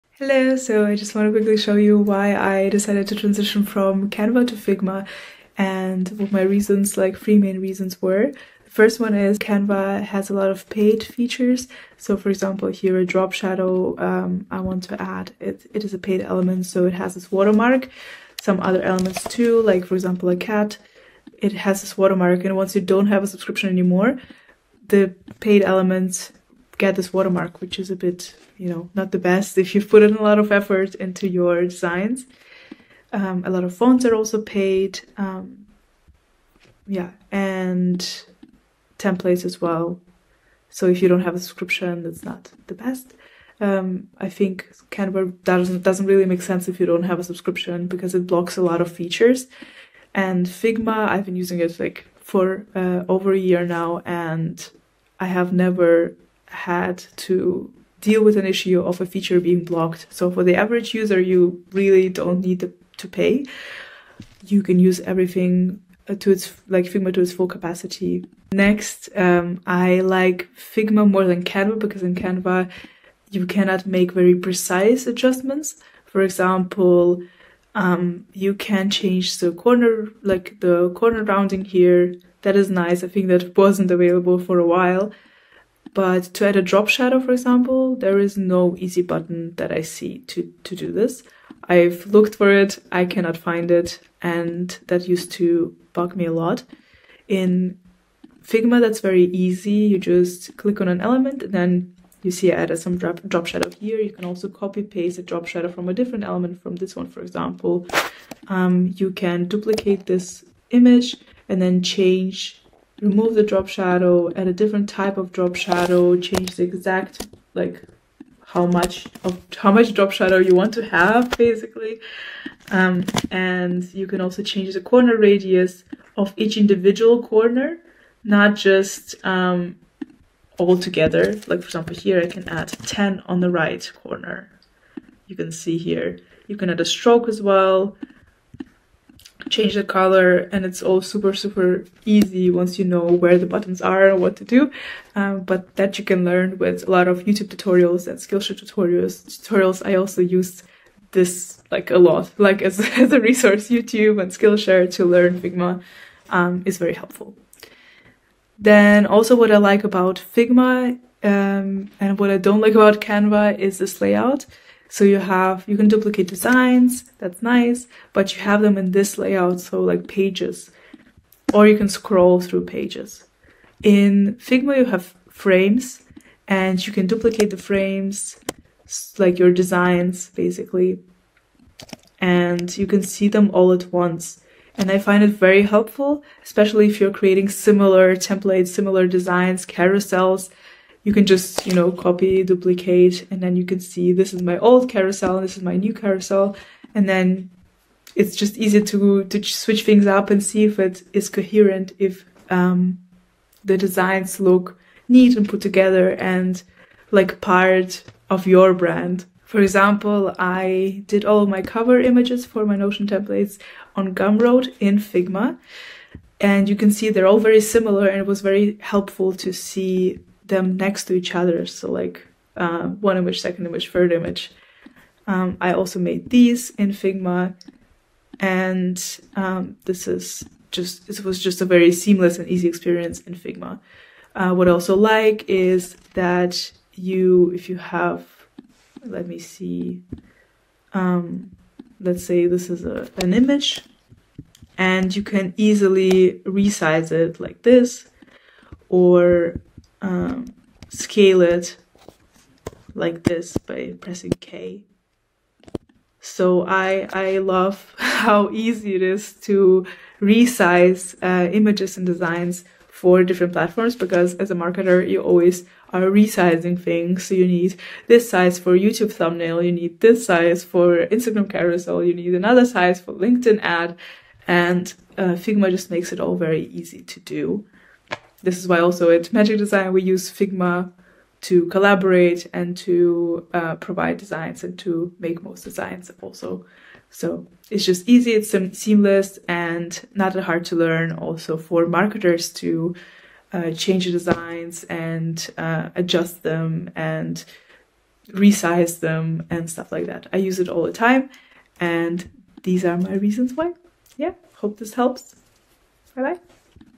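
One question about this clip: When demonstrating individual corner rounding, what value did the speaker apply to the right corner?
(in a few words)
10.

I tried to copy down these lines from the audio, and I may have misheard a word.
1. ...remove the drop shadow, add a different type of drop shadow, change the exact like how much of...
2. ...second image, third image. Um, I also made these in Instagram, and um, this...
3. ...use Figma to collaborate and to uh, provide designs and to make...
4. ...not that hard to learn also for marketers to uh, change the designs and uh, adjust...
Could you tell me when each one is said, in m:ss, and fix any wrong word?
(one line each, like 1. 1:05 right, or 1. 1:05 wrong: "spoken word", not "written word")
1. 1:53 right
2. 3:43 wrong: "Figma", not "Instagram"
3. 4:40 right
4. 4:50 right.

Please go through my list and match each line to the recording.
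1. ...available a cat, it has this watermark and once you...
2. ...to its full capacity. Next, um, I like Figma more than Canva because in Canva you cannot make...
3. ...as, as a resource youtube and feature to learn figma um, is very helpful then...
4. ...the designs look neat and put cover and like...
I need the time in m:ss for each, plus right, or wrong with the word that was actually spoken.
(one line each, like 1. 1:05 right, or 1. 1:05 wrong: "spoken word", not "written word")
1. 0:19 wrong: "example", not "available"
2. 1:07 right
3. 2:32 wrong: "skillshare", not "feature"
4. 3:23 wrong: "together", not "cover".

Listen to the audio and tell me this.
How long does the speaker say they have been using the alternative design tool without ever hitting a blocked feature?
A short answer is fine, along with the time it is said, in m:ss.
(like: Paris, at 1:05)
Over a year, at 0:53.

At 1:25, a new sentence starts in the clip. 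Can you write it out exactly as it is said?
But to add a drop shadow, for example, there is no easy button that I see to, to do this.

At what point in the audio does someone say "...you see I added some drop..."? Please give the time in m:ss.
1:42.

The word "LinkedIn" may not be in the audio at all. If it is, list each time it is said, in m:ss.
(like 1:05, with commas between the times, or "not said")
4:33.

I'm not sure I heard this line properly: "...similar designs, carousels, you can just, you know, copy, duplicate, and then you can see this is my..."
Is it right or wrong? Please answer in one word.
right.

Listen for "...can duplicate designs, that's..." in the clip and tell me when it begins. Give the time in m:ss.
2:45.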